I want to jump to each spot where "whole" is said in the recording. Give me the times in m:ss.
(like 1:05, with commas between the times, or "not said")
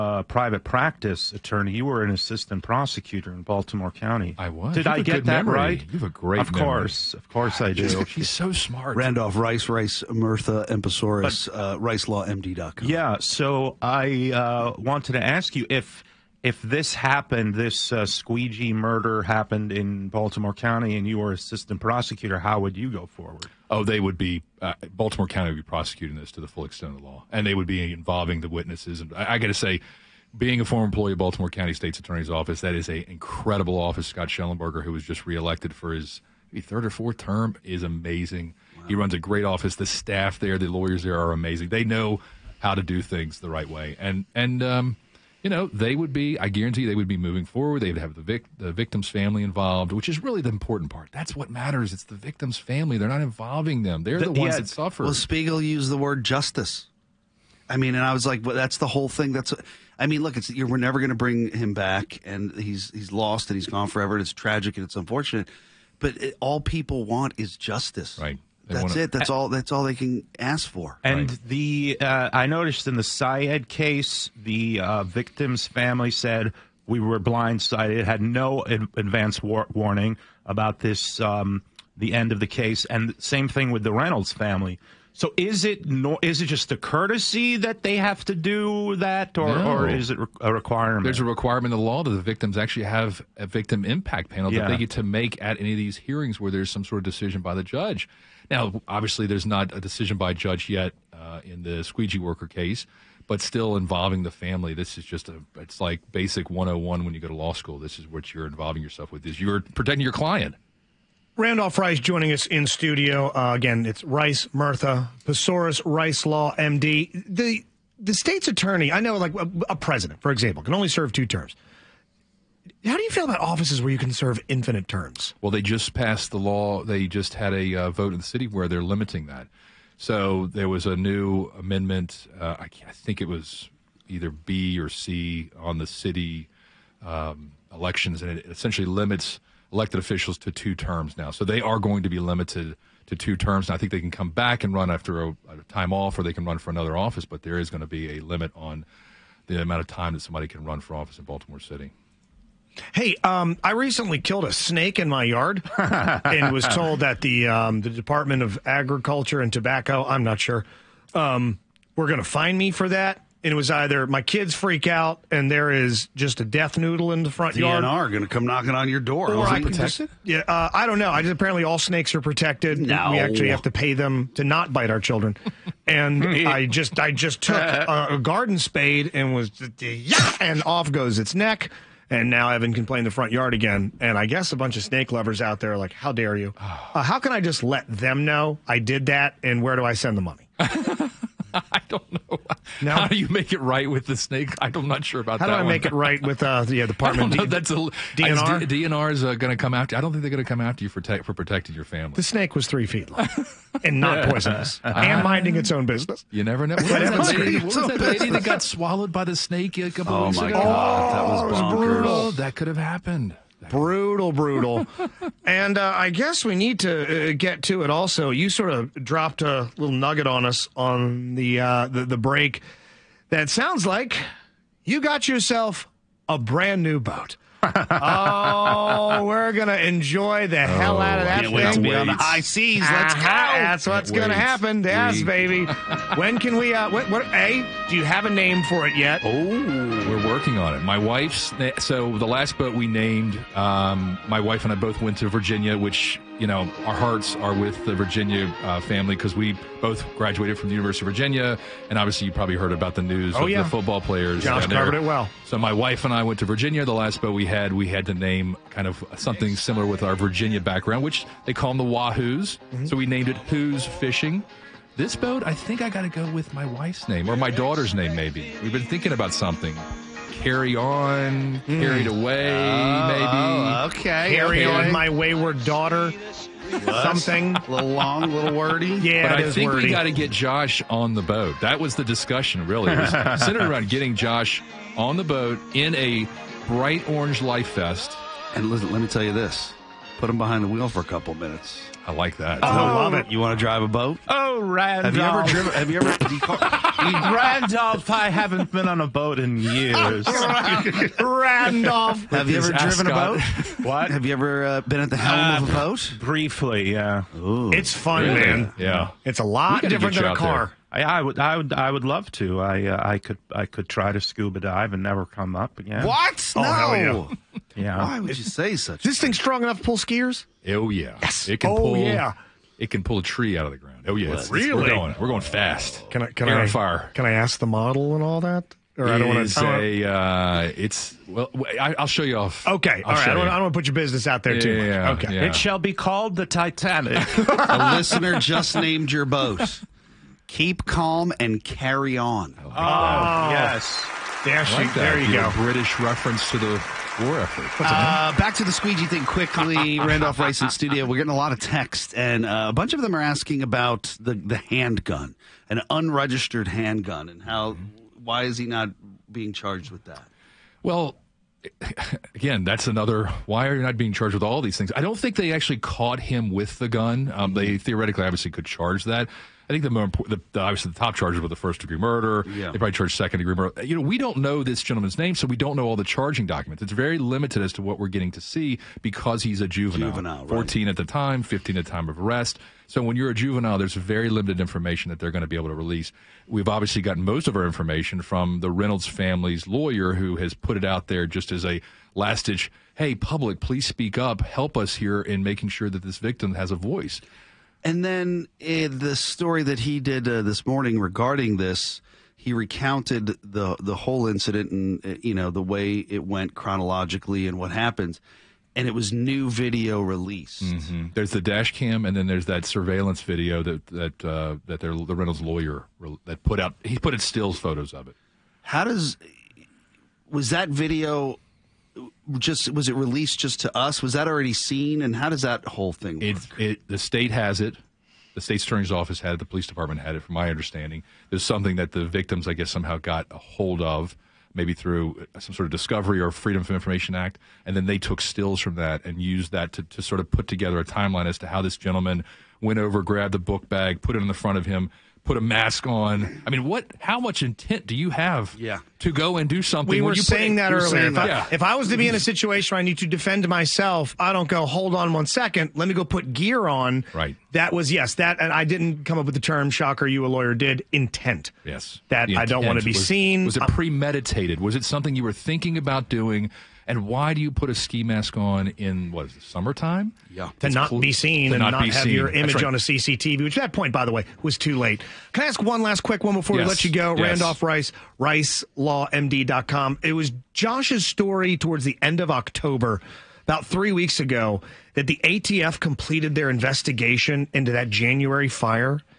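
0:58, 6:43, 7:05.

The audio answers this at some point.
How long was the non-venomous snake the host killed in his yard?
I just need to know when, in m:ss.
3:22.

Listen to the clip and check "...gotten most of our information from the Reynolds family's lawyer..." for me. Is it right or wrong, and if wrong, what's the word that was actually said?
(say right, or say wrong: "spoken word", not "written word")
right.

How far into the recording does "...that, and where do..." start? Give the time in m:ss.
3:09.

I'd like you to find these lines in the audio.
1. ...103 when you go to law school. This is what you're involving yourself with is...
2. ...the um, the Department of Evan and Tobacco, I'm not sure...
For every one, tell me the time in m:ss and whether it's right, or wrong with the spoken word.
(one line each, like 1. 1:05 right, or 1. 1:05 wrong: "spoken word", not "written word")
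1. 1:46 wrong: "101", not "103"
2. 2:37 wrong: "Agriculture", not "Evan".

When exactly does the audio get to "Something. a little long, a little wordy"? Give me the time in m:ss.
4:36.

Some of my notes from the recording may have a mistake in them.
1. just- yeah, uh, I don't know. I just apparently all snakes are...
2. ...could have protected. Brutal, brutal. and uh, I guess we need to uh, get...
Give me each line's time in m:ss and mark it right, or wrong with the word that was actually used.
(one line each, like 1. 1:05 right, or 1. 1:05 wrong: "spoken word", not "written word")
1. 2:50 right
2. 3:32 wrong: "happened", not "protected".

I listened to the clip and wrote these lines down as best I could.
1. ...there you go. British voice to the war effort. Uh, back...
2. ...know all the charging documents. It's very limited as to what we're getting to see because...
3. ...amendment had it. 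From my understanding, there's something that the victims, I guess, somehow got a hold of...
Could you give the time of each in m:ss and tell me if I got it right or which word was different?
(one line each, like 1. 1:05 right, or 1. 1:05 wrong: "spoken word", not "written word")
1. 5:44 wrong: "reference", not "voice"
2. 6:15 right
3. 7:09 wrong: "department", not "amendment".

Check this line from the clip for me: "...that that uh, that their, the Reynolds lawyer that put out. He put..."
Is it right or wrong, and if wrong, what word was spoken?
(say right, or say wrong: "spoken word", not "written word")
right.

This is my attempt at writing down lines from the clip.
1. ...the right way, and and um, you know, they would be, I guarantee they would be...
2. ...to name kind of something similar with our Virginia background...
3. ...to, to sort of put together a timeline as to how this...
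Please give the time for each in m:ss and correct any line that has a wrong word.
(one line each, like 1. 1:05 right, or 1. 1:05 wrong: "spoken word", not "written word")
1. 0:43 right
2. 4:18 right
3. 7:19 right.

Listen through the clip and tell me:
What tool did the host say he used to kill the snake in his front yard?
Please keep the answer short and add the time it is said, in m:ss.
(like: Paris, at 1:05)
garden spade, at 2:58.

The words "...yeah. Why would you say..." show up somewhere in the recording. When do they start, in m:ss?
5:17.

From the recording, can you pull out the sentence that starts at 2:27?
But there is going to be a limit on the amount of time that somebody can run for office in Baltimore City.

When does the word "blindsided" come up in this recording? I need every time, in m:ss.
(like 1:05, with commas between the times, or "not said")
1:17.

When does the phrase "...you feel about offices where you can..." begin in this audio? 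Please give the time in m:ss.
2:03.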